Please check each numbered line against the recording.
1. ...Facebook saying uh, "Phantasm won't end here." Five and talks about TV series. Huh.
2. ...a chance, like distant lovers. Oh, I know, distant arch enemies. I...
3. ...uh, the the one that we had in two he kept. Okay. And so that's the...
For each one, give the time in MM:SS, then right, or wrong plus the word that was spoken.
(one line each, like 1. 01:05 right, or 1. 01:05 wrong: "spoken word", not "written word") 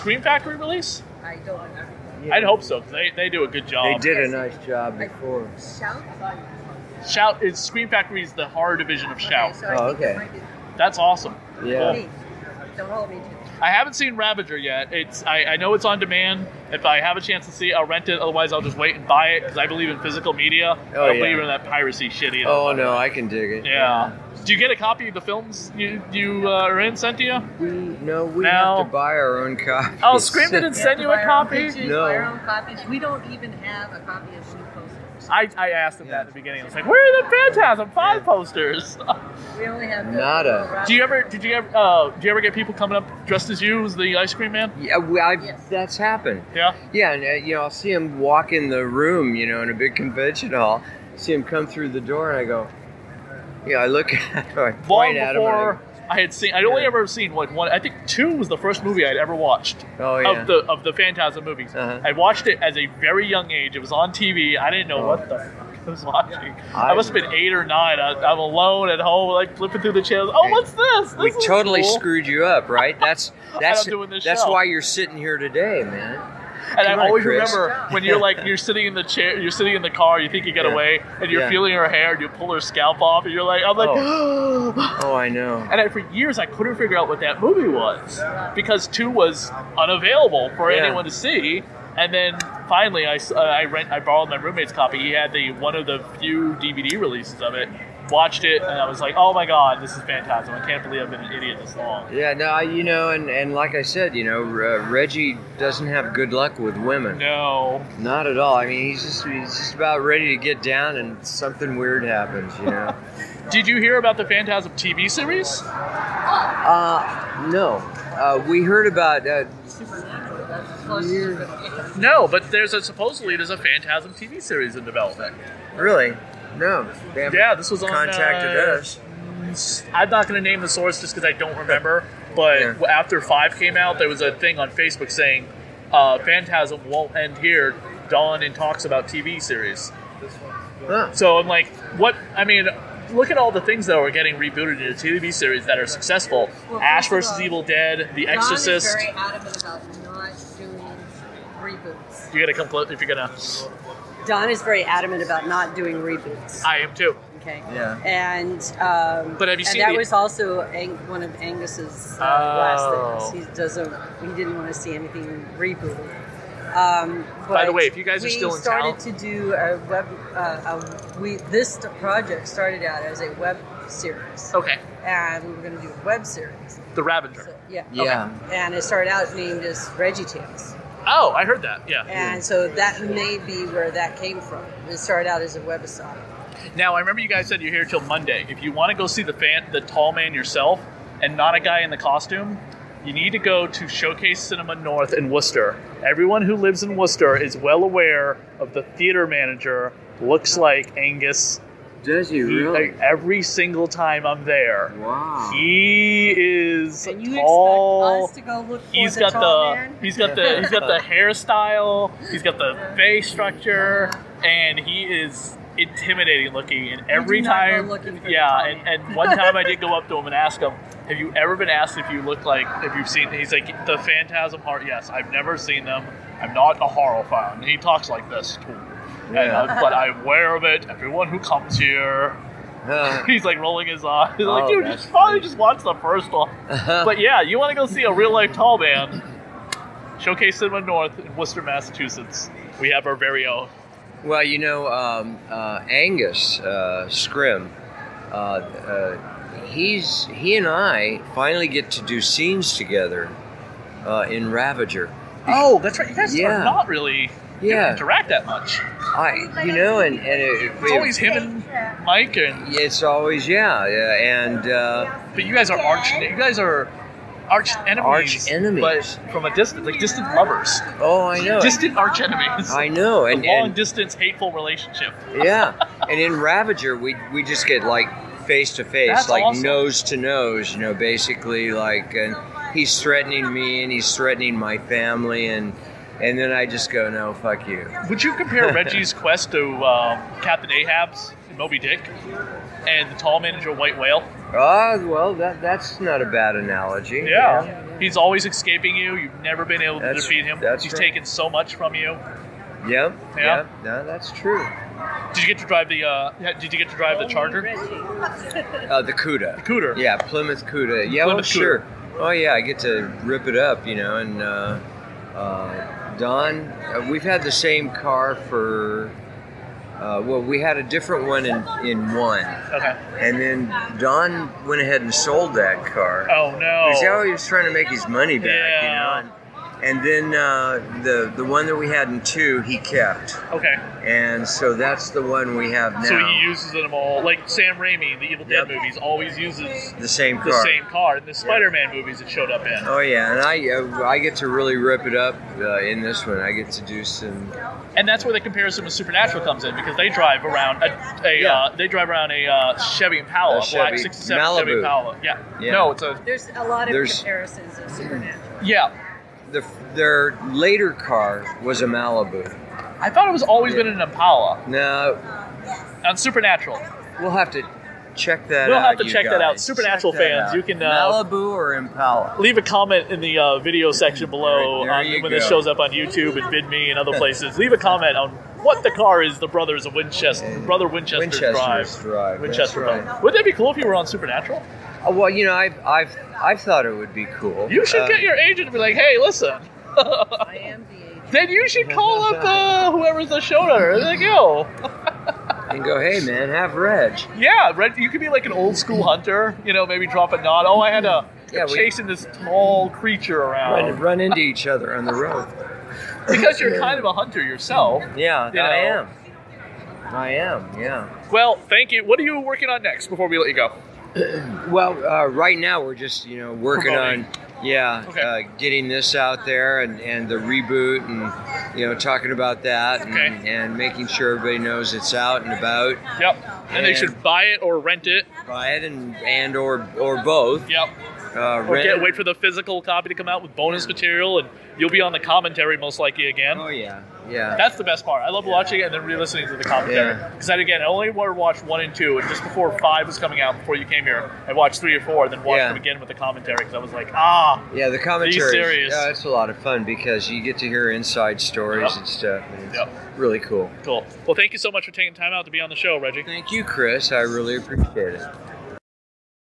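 1. 02:14 wrong: "Don", not "Five"
2. 04:29 wrong: "distance", not "chance"
3. 05:30 right.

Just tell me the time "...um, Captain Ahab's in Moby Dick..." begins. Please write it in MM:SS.
04:49.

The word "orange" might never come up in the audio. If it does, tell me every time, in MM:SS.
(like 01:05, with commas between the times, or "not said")
not said.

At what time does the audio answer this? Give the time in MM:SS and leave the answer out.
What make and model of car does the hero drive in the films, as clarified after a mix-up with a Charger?
05:10.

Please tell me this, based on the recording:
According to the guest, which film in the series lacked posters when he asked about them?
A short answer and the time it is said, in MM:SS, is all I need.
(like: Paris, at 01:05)
Phantasm Five, at 00:37.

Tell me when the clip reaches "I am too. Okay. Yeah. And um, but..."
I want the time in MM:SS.
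02:36.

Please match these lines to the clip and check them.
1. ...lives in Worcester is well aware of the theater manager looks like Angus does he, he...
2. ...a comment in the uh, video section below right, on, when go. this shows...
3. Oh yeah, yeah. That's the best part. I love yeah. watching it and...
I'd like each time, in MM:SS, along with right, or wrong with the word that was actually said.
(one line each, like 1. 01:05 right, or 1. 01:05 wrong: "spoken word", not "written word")
1. 03:16 right
2. 06:12 right
3. 07:16 right.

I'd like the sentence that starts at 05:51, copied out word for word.
Uh, they drive around a uh, Chevy Impala, a Chevy, black '67 Chevy Impala.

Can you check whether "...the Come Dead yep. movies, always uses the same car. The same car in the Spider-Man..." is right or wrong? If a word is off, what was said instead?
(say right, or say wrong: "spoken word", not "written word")
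wrong: "Evil", not "Come".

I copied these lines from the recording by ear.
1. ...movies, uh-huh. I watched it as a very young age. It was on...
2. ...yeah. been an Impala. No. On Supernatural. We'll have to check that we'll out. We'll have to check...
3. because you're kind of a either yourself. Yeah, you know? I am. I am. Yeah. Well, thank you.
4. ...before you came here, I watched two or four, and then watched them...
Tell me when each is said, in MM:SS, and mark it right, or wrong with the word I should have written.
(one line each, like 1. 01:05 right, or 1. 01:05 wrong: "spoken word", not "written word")
1. 01:01 right
2. 06:03 right
3. 06:46 wrong: "hunter", not "either"
4. 07:23 wrong: "three", not "two".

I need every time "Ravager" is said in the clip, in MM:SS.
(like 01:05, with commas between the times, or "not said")
00:14, 02:57, 04:14, 04:36.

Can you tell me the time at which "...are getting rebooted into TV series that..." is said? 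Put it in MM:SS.
02:23.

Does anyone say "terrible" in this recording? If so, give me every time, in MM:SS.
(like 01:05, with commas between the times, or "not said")
not said.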